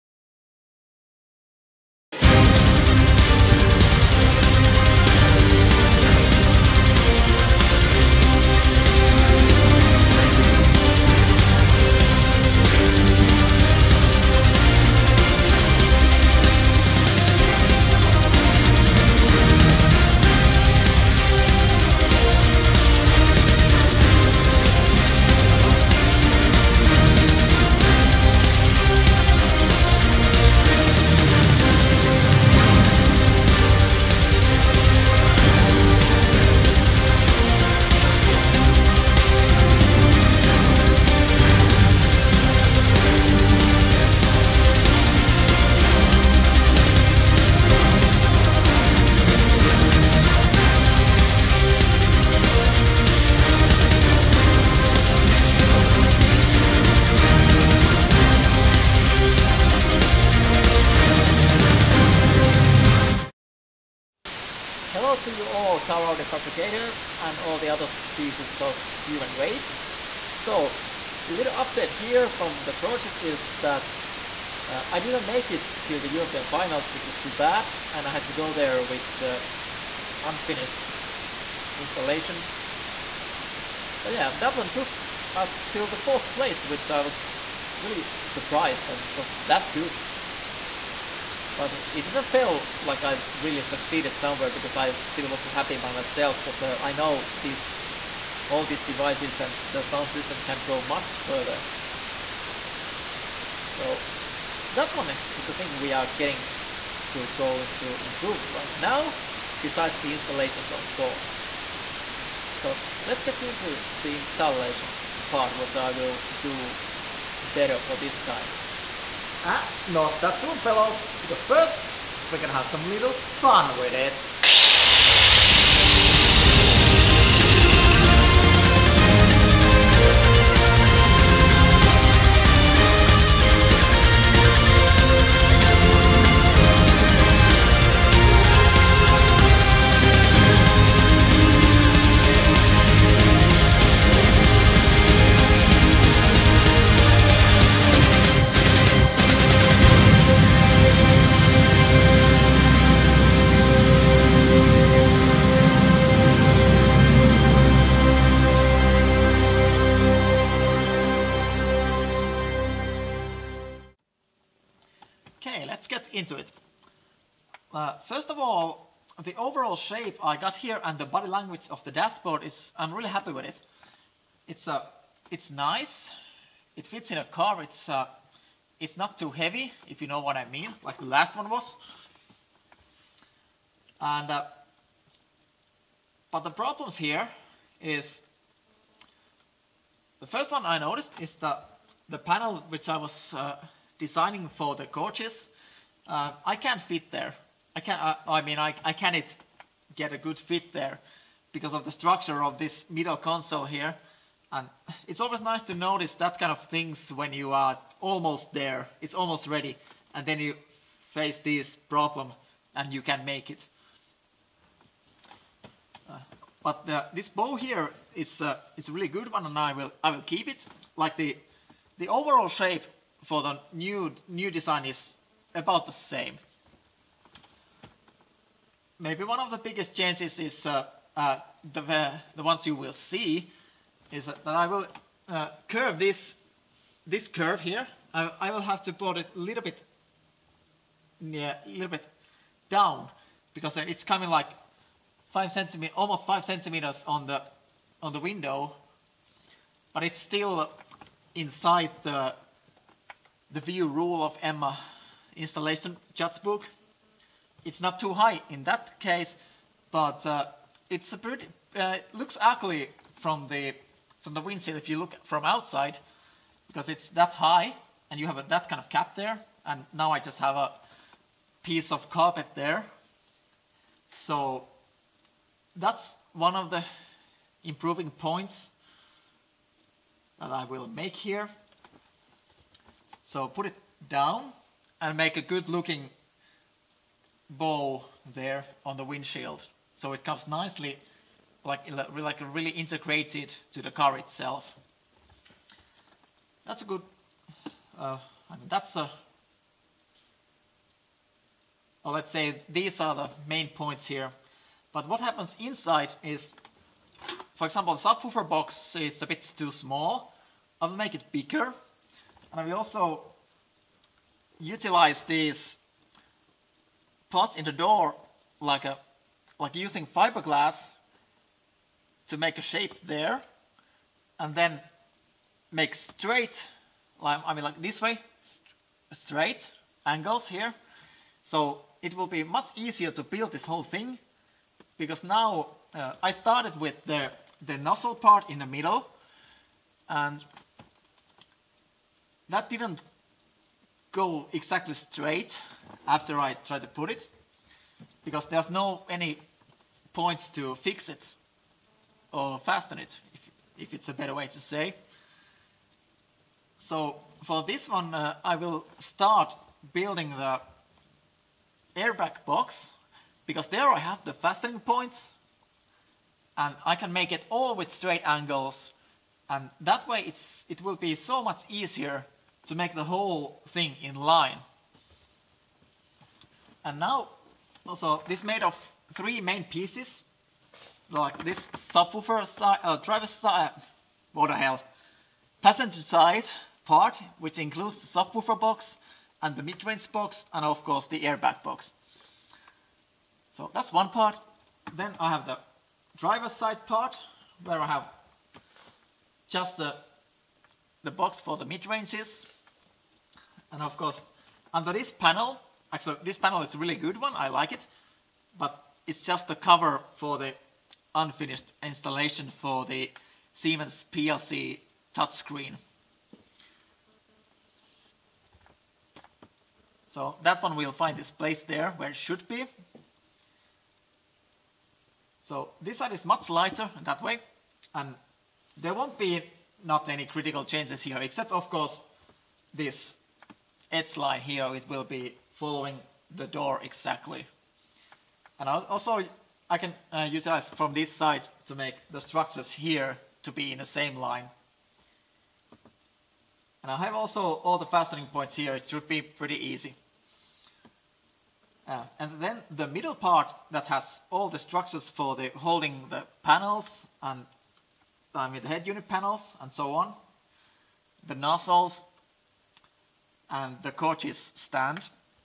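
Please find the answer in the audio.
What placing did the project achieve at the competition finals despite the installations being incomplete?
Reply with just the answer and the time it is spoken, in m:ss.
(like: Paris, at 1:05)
4th place, at 1:25.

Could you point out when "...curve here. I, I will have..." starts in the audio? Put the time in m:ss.
3:57.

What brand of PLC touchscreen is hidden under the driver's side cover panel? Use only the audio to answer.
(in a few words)
Siemens.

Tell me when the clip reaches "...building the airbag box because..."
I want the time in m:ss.
5:59.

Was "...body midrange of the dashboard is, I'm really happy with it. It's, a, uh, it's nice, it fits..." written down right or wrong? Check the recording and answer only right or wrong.
wrong.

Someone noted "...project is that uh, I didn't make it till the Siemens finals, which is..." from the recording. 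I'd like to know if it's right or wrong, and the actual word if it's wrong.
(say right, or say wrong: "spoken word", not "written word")
wrong: "European", not "Siemens".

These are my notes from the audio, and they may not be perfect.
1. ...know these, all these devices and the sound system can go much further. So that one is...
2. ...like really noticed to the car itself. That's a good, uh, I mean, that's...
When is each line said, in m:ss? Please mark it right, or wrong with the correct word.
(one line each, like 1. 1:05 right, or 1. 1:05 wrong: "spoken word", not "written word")
1. 1:36 right
2. 4:51 wrong: "integrated", not "noticed".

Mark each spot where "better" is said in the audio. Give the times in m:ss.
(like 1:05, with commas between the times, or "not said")
1:57, 5:54.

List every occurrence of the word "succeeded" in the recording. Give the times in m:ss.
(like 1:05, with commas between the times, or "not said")
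1:33.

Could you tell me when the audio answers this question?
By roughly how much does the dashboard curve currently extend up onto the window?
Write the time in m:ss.
4:06.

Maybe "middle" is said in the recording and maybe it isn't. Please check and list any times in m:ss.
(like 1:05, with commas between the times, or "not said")
3:22, 5:38, 7:32.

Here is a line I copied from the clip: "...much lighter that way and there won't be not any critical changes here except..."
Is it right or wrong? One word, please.
right.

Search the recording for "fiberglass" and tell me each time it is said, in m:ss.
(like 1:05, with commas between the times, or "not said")
5:20.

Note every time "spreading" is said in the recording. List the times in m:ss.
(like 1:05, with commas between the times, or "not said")
not said.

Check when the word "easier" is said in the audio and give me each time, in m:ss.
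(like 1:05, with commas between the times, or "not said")
5:32, 6:11.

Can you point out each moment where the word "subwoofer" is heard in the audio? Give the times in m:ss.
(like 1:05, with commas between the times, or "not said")
5:08, 6:21, 6:28.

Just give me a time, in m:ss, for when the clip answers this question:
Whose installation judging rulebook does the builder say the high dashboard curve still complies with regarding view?
4:14.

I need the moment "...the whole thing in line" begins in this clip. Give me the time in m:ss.
6:12.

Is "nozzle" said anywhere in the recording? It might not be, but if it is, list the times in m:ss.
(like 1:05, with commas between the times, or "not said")
5:37, 7:41.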